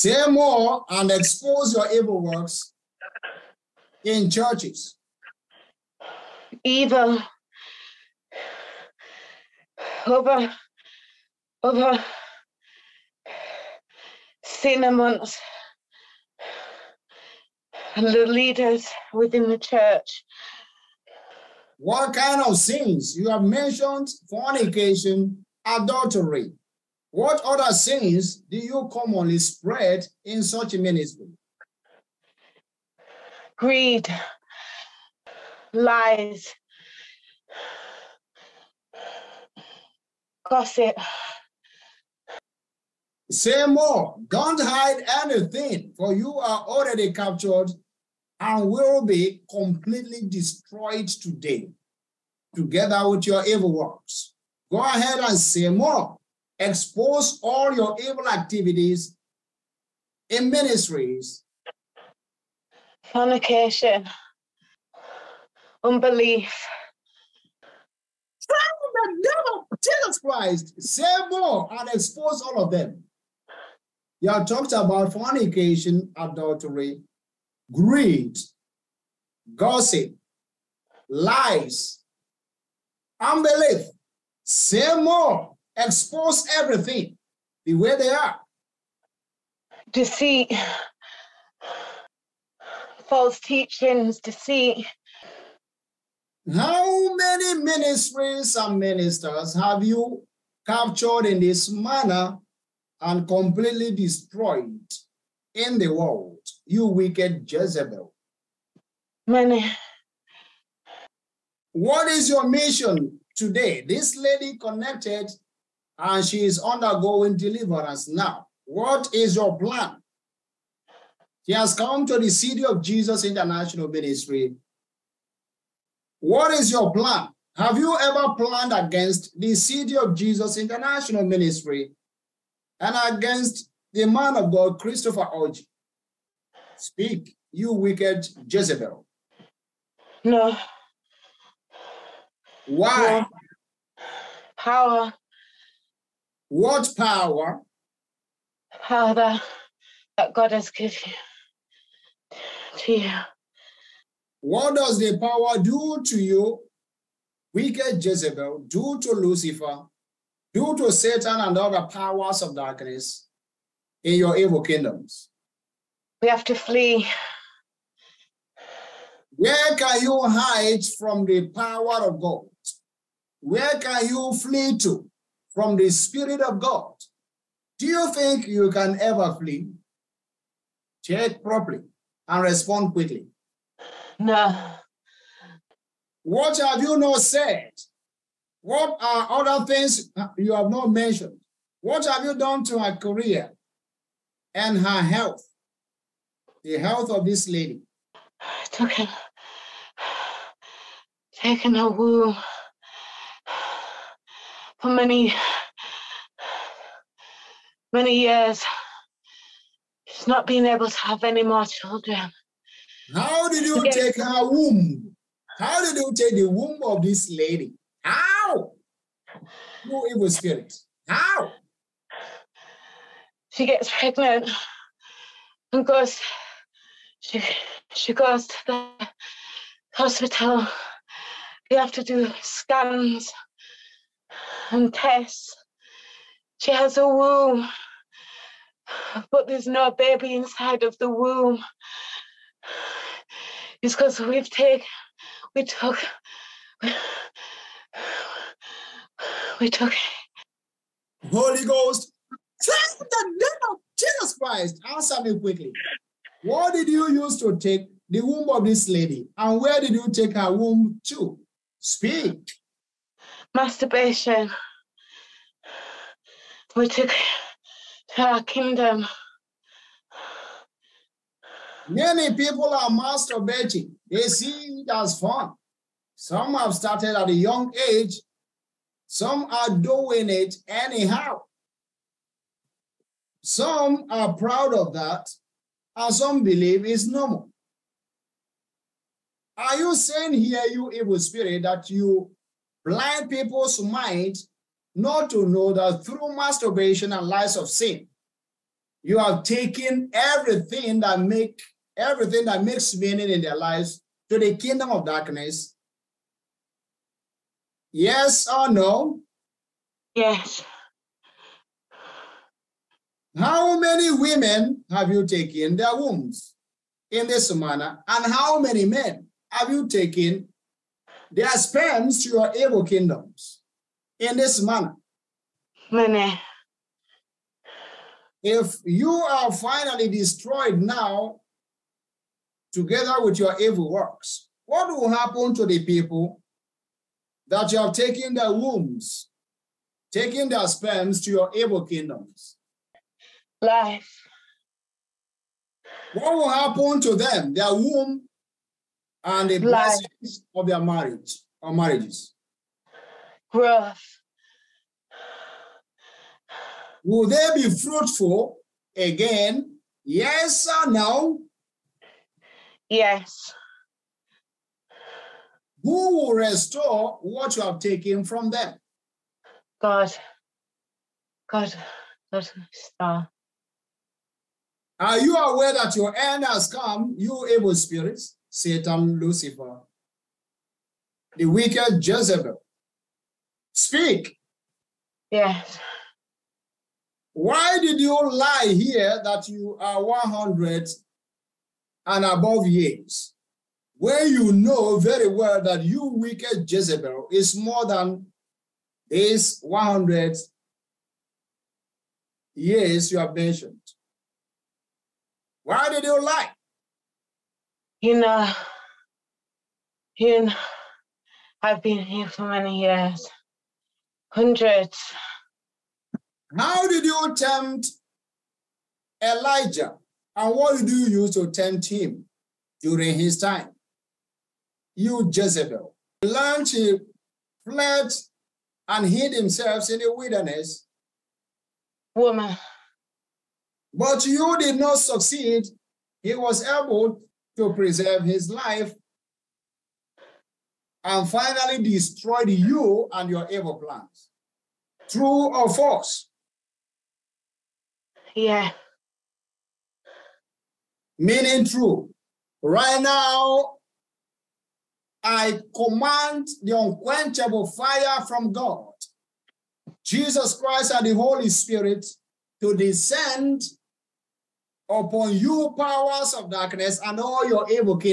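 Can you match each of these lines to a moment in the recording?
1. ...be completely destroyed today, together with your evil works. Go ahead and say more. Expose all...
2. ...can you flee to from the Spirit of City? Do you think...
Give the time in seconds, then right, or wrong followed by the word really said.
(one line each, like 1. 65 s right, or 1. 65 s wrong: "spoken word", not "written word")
1. 49 s right
2. 173 s wrong: "God", not "City".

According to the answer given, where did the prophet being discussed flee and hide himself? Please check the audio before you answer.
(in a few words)
The wilderness.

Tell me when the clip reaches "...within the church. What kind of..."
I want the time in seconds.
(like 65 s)
19 s.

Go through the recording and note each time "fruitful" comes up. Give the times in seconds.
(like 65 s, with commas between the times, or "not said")
357 s.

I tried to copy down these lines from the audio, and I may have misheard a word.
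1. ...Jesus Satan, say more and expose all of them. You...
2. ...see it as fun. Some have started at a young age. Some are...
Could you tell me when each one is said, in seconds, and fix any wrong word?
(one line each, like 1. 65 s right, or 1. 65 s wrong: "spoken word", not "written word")
1. 69 s wrong: "Christ", not "Satan"
2. 274 s right.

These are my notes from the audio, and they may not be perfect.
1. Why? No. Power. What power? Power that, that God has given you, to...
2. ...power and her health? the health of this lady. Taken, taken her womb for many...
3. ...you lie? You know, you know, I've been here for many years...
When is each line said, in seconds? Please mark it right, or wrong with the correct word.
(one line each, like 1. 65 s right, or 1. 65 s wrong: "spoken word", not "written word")
1. 142 s right
2. 192 s wrong: "career", not "power"
3. 406 s right.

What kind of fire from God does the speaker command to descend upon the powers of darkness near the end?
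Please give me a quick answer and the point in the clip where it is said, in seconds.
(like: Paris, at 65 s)
Unquenchable fire, at 456 s.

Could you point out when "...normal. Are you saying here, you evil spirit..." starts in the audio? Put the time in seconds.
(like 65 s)
287 s.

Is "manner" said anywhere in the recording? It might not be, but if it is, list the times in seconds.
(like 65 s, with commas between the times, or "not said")
101 s, 317 s, 324 s.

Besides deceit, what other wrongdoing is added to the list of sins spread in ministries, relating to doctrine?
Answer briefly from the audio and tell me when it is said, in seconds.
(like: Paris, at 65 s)
False teachings, at 93 s.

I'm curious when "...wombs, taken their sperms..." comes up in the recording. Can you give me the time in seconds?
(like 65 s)
338 s.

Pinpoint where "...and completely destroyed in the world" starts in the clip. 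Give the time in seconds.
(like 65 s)
102 s.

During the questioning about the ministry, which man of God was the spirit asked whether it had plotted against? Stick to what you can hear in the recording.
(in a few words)
Christopher Orji.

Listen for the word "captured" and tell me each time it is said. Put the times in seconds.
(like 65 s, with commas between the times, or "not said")
47 s, 100 s.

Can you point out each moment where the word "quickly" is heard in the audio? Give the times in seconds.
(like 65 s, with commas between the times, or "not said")
182 s, 255 s.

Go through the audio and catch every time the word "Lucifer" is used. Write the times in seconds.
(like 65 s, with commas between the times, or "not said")
159 s, 379 s.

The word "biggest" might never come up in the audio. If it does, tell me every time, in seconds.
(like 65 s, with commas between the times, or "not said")
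not said.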